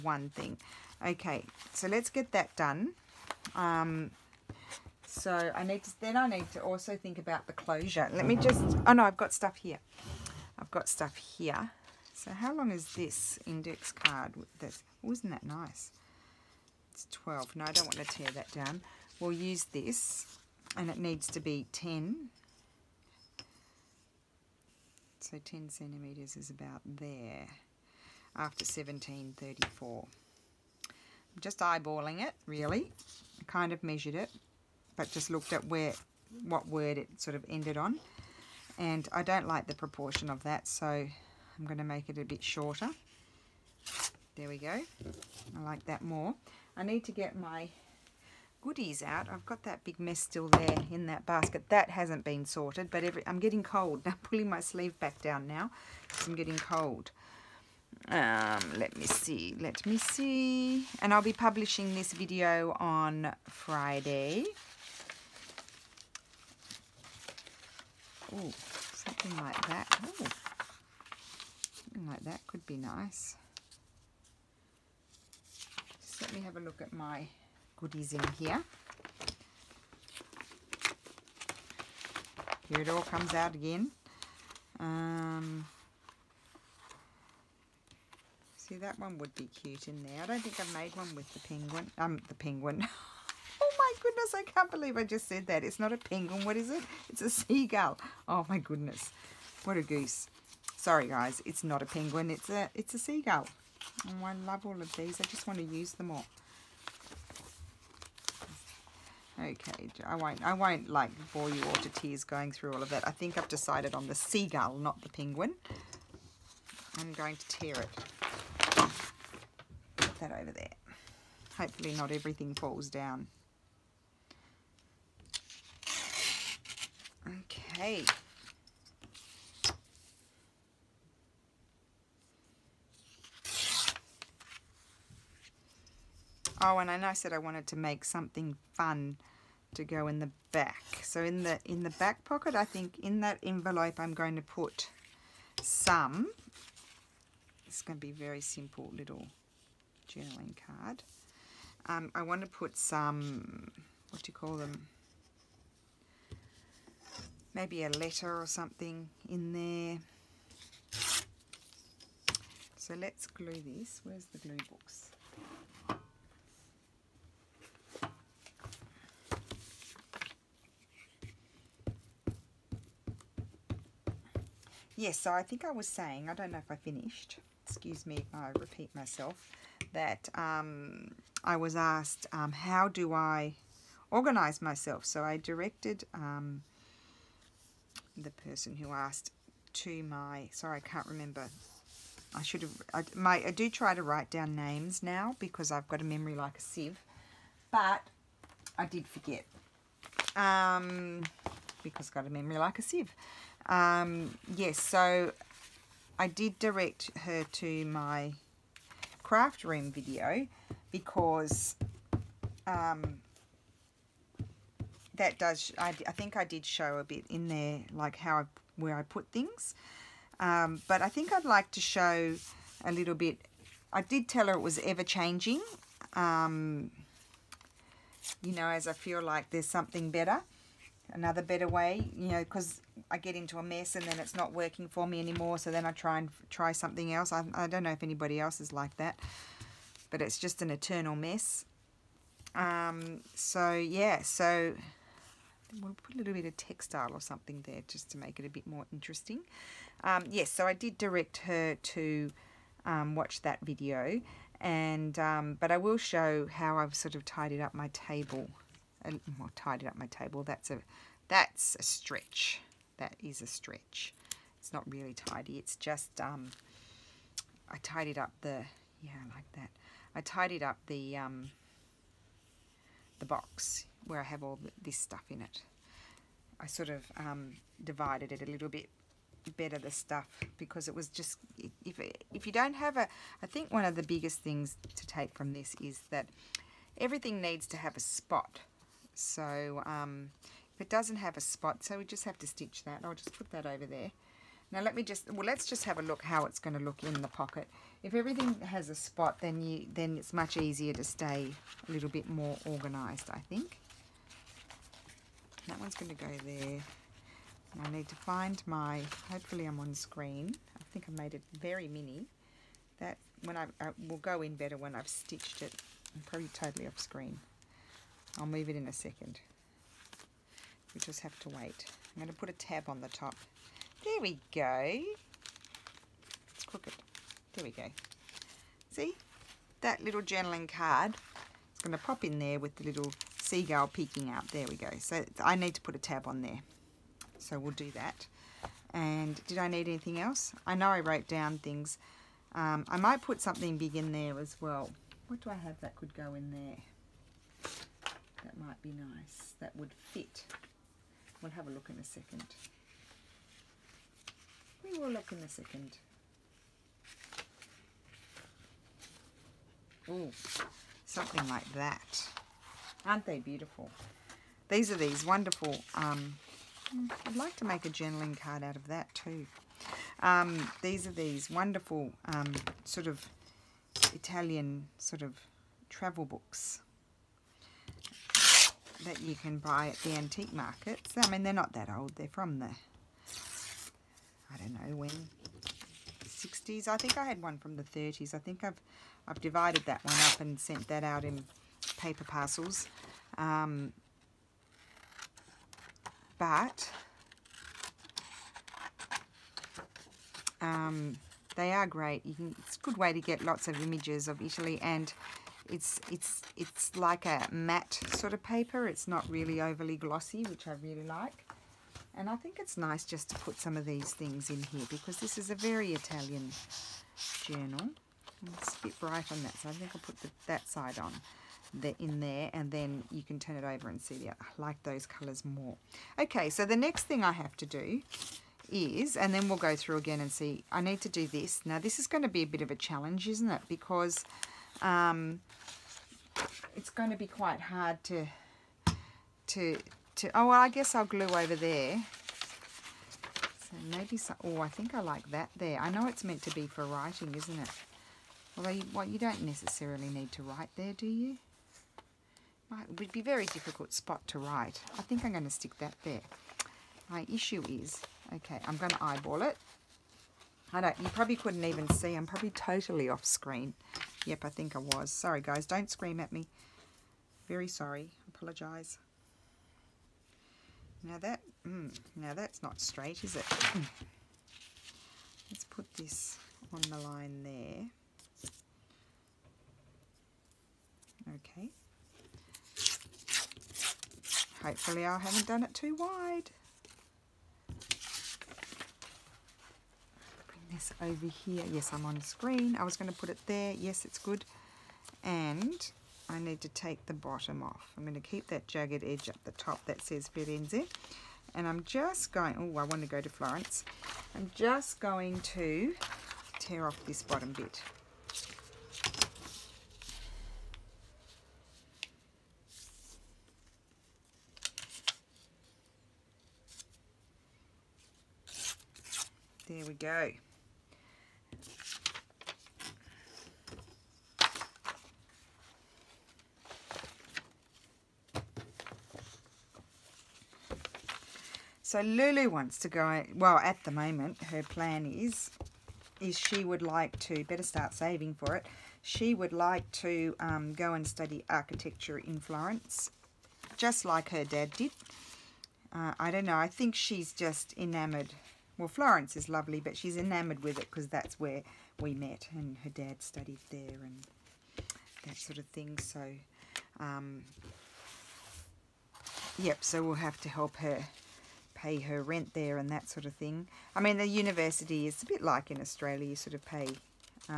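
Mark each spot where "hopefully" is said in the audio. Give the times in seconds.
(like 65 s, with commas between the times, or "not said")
121 s, 309 s, 484 s.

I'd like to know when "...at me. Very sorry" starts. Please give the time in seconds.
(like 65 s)
466 s.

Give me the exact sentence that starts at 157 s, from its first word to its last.
Maybe a letter or something in there.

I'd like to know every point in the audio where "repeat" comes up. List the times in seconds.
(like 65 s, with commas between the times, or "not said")
178 s.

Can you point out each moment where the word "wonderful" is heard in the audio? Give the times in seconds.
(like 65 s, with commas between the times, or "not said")
365 s, 371 s.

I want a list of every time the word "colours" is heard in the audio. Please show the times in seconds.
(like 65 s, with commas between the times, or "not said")
425 s.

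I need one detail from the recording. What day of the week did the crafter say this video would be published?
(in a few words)
Friday.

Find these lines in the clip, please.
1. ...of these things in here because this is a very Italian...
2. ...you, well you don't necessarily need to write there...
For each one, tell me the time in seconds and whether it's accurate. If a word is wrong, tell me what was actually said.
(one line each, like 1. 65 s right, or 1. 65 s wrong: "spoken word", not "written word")
1. 413 s right
2. 448 s right.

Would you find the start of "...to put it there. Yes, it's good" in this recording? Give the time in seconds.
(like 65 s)
493 s.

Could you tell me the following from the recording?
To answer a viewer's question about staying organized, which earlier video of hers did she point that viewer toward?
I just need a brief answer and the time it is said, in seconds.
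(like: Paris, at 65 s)
Craft room video, at 209 s.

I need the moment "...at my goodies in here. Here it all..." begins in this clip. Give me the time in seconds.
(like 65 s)
76 s.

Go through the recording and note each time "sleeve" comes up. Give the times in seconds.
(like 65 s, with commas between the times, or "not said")
54 s.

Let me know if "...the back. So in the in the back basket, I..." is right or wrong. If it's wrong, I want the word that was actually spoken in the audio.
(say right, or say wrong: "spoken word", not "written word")
wrong: "pocket", not "basket".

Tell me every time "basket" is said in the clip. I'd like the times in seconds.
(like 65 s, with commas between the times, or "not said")
51 s.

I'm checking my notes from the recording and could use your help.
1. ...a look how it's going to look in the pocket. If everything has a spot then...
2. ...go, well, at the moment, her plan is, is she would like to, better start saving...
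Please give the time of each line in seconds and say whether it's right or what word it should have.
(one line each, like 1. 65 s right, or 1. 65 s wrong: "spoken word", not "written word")
1. 295 s right
2. 532 s right.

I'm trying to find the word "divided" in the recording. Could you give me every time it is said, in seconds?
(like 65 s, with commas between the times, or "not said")
277 s, 389 s.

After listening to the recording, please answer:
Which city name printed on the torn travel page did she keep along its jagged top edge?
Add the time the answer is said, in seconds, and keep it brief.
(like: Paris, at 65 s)
Firenze, at 500 s.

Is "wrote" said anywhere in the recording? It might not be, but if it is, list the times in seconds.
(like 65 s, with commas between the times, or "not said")
340 s.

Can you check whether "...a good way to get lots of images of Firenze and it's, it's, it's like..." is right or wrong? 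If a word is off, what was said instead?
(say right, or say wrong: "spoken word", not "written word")
wrong: "Italy", not "Firenze".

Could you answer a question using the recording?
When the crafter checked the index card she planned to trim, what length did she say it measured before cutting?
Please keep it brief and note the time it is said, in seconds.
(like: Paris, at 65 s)
12, at 16 s.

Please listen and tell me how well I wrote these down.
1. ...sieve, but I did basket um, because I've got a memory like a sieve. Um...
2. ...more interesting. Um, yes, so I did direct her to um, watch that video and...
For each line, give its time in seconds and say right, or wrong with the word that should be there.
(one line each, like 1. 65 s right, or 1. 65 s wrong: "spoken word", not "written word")
1. 196 s wrong: "forget", not "basket"
2. 248 s right.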